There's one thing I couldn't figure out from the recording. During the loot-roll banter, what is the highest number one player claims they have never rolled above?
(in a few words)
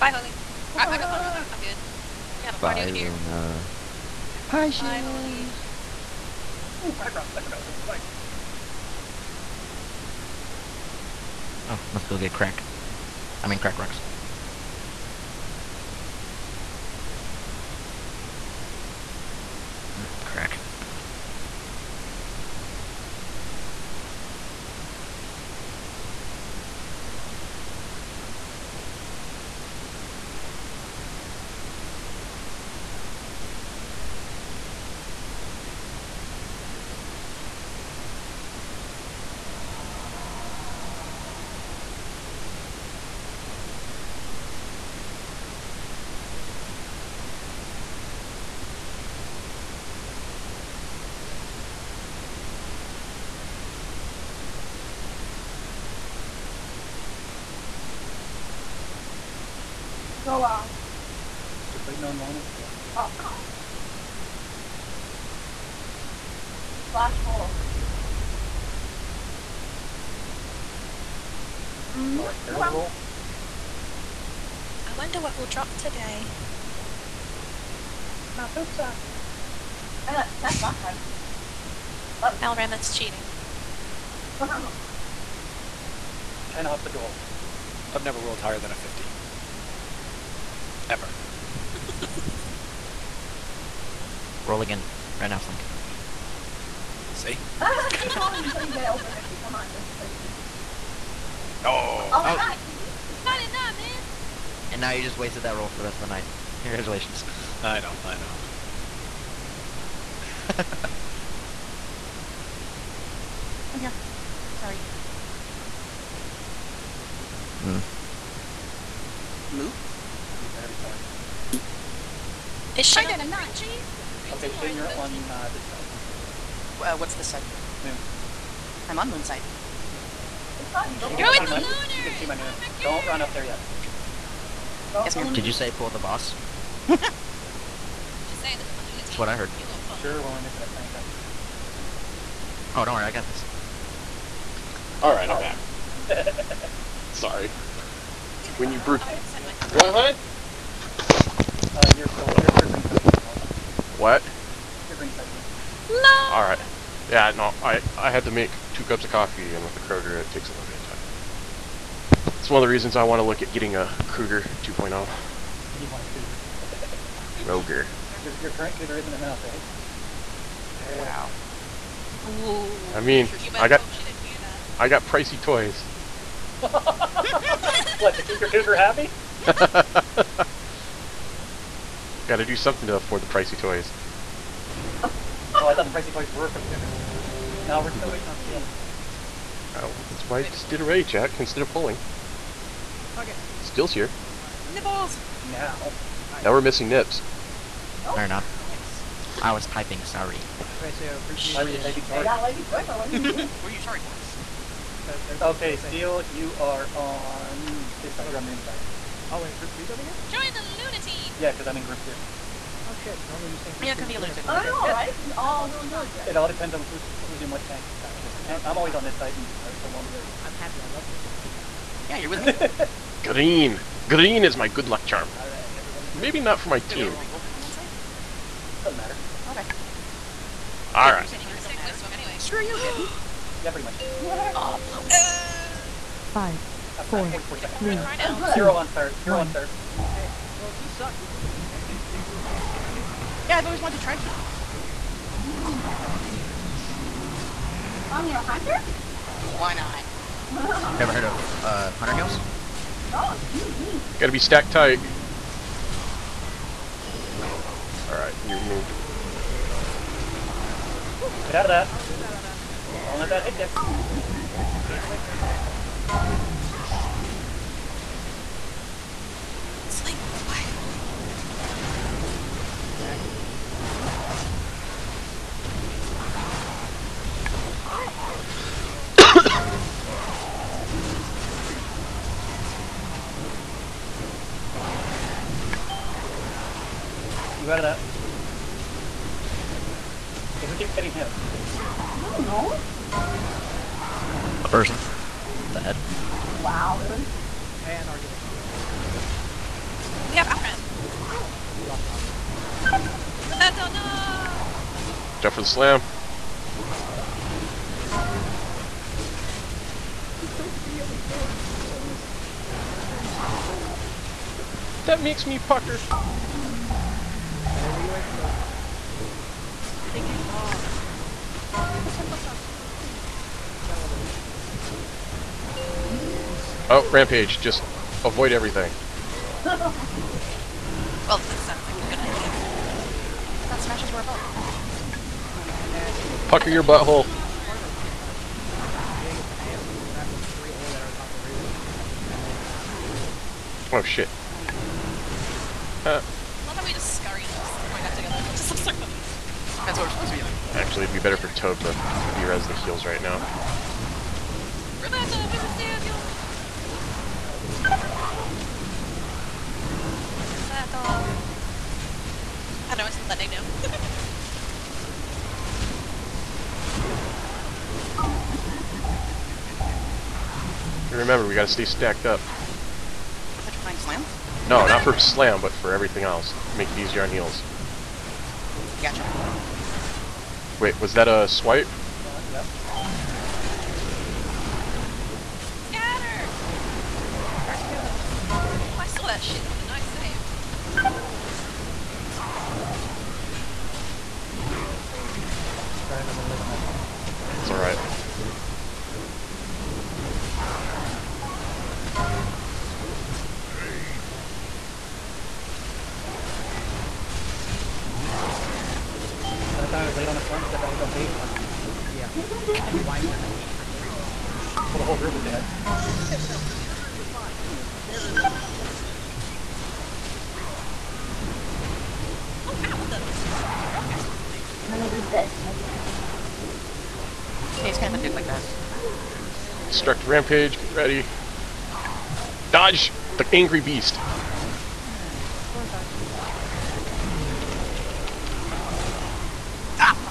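50.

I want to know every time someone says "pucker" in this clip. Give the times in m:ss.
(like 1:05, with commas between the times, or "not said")
5:15, 5:36.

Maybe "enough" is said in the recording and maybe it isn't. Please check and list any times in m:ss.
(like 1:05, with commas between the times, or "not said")
2:49, 3:18.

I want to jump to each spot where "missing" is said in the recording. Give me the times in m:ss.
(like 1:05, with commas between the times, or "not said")
2:20, 3:16.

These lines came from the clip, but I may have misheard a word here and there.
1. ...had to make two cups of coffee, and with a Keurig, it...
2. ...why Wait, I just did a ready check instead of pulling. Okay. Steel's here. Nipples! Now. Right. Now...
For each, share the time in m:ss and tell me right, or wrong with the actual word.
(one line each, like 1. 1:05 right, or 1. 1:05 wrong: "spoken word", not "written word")
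1. 2:38 right
2. 3:10 right.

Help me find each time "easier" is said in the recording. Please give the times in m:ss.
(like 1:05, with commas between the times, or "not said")
6:16.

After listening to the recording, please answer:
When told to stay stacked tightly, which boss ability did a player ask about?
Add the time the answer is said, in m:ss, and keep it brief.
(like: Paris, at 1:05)
Petrifying Slam, at 6:13.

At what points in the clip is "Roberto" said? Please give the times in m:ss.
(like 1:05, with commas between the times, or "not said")
5:03.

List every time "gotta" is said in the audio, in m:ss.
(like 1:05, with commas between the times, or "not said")
4:14, 6:11.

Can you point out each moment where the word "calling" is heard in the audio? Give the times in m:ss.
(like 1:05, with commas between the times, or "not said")
not said.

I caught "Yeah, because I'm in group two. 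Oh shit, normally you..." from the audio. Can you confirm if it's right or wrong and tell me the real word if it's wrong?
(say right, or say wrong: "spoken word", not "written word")
right.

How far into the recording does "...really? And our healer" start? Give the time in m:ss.
4:57.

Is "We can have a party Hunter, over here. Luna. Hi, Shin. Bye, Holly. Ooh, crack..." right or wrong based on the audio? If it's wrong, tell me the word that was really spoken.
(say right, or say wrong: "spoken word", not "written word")
wrong: "Bye", not "Hunter".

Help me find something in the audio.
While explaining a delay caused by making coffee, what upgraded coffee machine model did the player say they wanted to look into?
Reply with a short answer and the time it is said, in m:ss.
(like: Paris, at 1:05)
Keurig 2.0, at 2:44.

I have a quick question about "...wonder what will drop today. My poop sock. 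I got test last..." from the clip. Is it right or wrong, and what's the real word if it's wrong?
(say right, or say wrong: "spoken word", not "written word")
right.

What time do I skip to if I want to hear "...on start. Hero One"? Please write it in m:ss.
3:58.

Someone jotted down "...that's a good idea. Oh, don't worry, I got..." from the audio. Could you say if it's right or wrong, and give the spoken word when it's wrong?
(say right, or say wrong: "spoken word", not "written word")
right.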